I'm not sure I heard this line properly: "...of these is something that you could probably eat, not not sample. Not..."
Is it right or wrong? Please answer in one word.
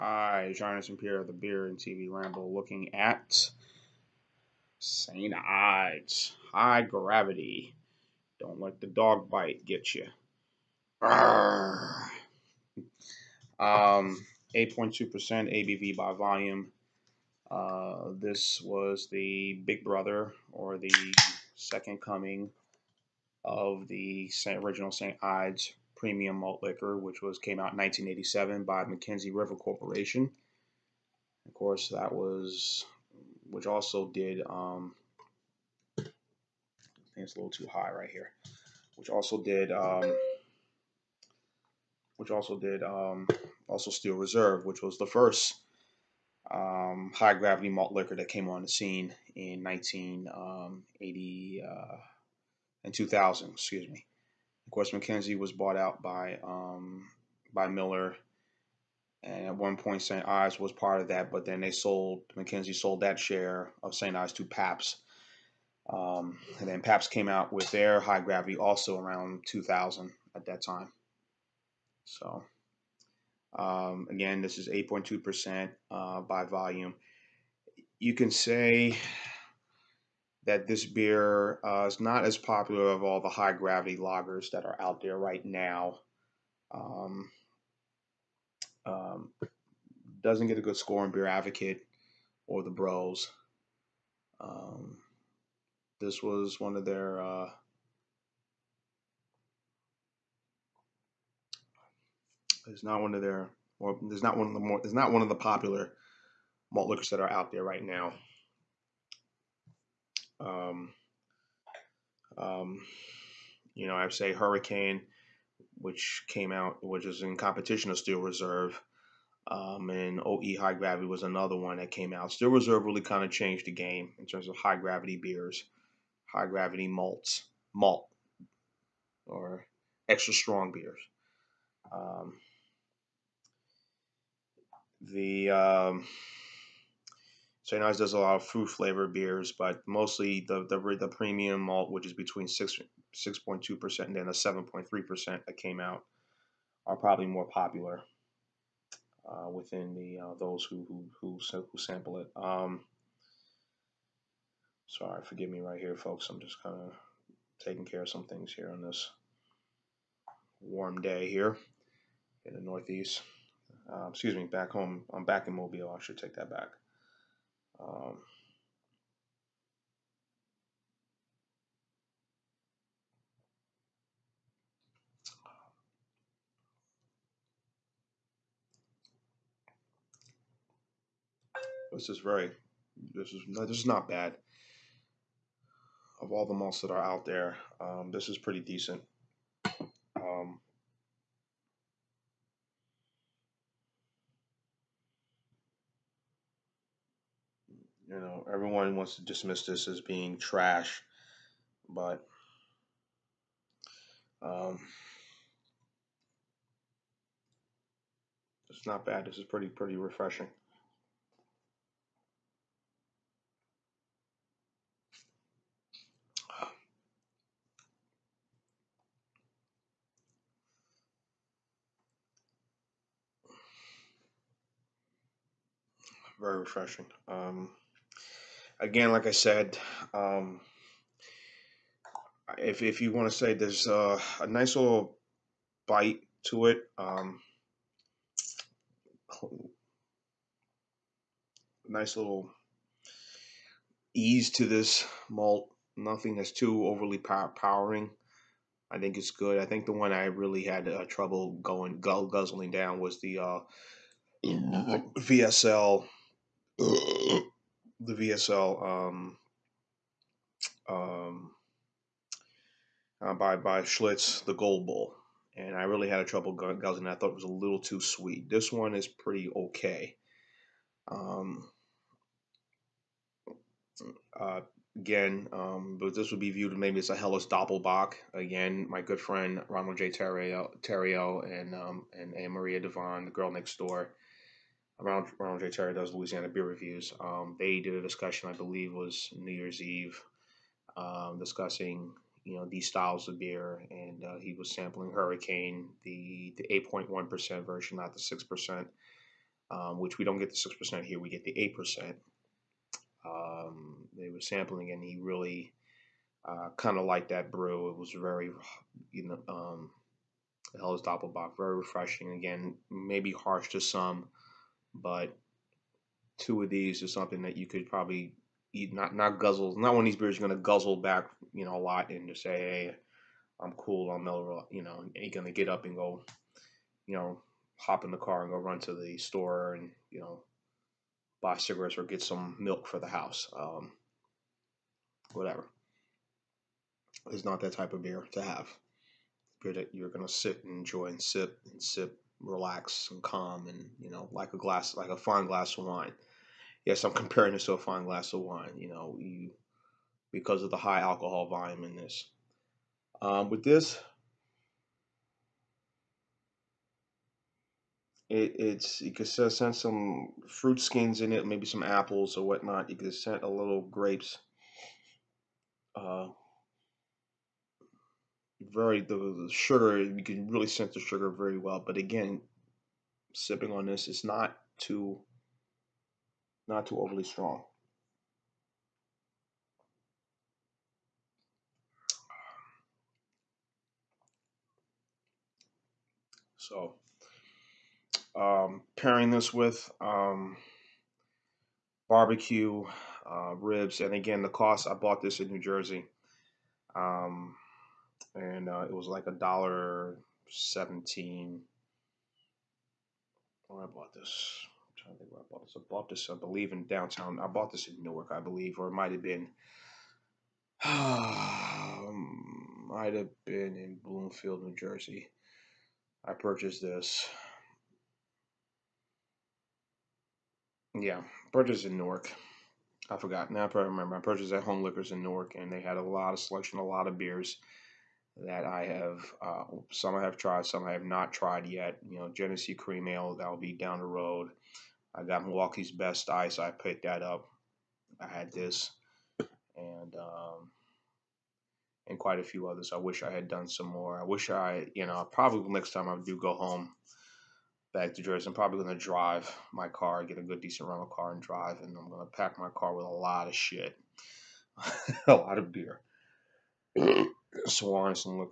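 wrong.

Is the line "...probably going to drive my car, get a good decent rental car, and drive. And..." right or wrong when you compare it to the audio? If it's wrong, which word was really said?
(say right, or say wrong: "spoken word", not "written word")
right.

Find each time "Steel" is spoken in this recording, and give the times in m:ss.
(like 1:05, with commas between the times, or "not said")
0:43, 1:57, 2:02.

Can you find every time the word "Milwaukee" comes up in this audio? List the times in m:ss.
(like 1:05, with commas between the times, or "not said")
7:15.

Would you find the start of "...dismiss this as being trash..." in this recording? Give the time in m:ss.
3:19.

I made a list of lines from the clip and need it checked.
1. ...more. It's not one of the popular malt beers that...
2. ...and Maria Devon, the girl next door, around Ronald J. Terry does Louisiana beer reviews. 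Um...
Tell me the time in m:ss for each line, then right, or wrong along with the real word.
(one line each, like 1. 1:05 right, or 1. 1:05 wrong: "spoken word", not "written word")
1. 1:44 wrong: "liquors", not "beers"
2. 4:42 right.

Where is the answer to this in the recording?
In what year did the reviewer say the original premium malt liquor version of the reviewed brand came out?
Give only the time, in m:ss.
0:27.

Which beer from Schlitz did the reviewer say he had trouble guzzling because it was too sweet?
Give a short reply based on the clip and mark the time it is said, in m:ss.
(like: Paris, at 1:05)
Gold Bull, at 4:24.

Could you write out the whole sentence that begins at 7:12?
You know, Genesee Cream Ale that'll be down the road.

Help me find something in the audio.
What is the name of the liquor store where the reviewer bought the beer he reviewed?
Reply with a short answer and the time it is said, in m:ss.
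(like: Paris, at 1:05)
Home Liquors, at 7:04.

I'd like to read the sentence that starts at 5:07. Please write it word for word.
It was very, you know, um, is Doppelbock, very refreshing.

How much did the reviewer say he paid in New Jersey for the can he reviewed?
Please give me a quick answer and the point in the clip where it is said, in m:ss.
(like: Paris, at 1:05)
$1.17, at 6:39.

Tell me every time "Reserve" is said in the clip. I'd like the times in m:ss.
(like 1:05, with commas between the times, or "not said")
0:44, 1:58, 2:02.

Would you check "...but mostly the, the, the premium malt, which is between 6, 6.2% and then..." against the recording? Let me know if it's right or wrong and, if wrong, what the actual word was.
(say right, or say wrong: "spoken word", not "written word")
right.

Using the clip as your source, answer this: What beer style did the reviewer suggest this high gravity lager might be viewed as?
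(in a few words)
Helles Doppelbock.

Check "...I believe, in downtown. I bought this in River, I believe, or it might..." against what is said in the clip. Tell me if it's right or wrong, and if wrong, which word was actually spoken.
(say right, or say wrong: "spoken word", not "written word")
wrong: "Newark", not "River".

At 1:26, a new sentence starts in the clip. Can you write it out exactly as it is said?
Um, um, doesn't get a good score in Beer Advocate or the Bros.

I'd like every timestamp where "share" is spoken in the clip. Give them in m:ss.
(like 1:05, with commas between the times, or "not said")
1:03.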